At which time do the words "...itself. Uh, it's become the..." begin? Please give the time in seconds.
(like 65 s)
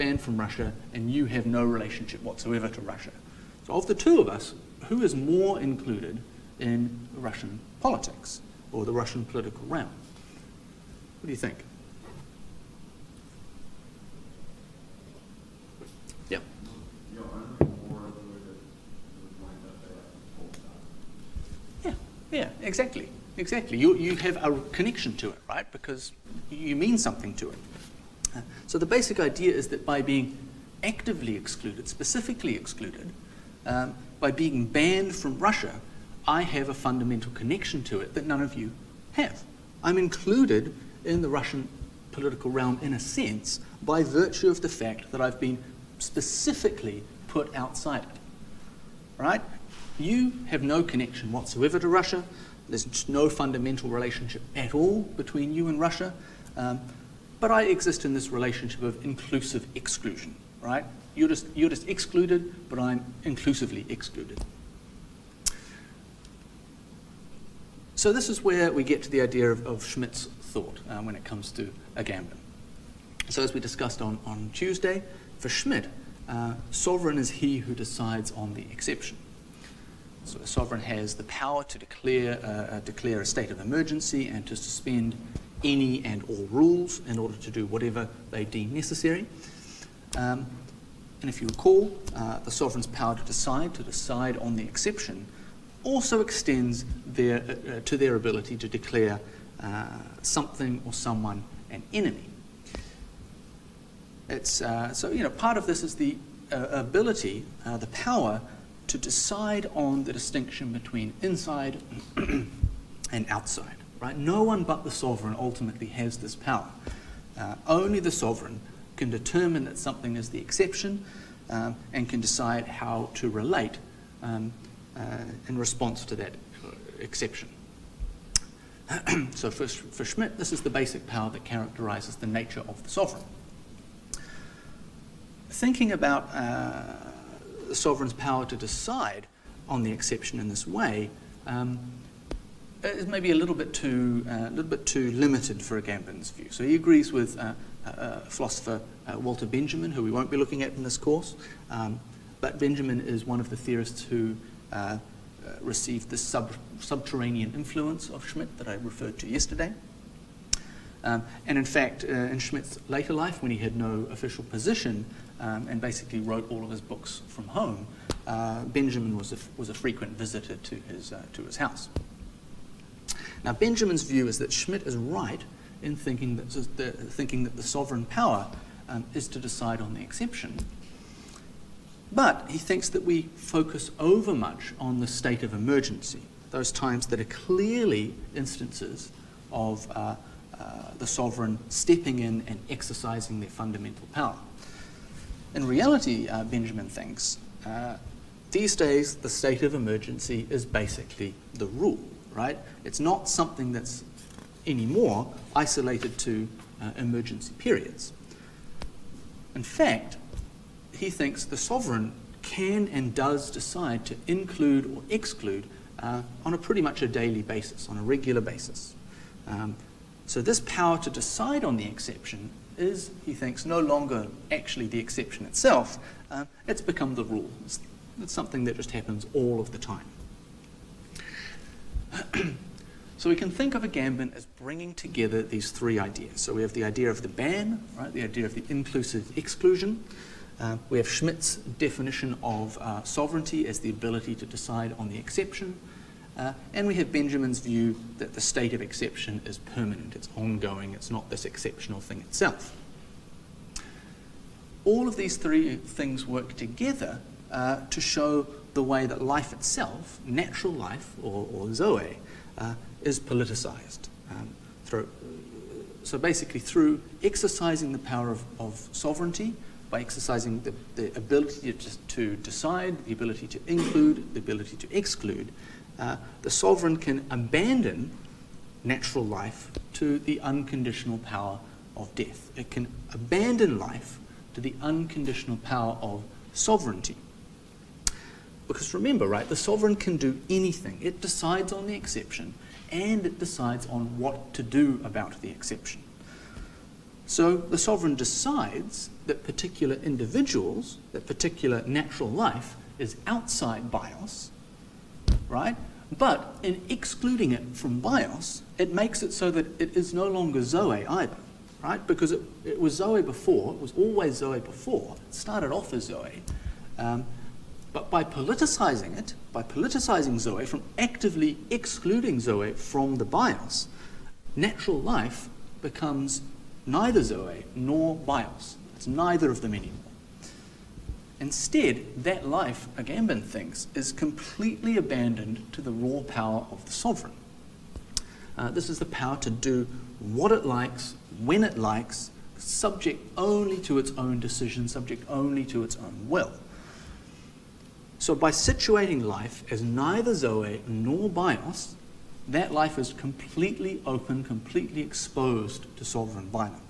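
225 s.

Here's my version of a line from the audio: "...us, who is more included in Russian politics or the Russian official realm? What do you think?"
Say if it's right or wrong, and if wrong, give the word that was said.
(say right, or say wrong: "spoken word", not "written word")
wrong: "political", not "official".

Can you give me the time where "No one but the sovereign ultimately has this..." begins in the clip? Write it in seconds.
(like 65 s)
114 s.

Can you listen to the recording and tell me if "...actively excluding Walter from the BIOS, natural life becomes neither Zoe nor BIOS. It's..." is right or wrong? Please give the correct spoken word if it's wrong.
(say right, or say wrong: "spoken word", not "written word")
wrong: "Zoe", not "Walter".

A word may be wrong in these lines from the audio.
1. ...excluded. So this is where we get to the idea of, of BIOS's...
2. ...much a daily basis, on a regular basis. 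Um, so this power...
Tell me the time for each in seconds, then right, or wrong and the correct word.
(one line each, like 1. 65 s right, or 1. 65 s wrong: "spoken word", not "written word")
1. 63 s wrong: "Schmitt", not "BIOS"
2. 216 s right.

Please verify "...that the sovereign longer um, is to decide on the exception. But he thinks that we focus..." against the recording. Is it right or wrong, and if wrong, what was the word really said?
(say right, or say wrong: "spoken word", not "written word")
wrong: "power", not "longer".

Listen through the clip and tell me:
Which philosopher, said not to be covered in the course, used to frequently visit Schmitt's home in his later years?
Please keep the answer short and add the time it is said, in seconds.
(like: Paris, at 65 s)
Walter Benjamin, at 149 s.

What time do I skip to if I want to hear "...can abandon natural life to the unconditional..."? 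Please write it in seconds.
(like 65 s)
276 s.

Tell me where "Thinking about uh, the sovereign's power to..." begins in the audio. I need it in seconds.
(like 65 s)
135 s.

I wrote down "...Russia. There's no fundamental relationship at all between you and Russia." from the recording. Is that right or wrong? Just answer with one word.
right.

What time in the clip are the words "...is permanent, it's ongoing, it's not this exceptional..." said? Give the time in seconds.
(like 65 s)
249 s.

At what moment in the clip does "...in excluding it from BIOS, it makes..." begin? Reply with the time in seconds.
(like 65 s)
306 s.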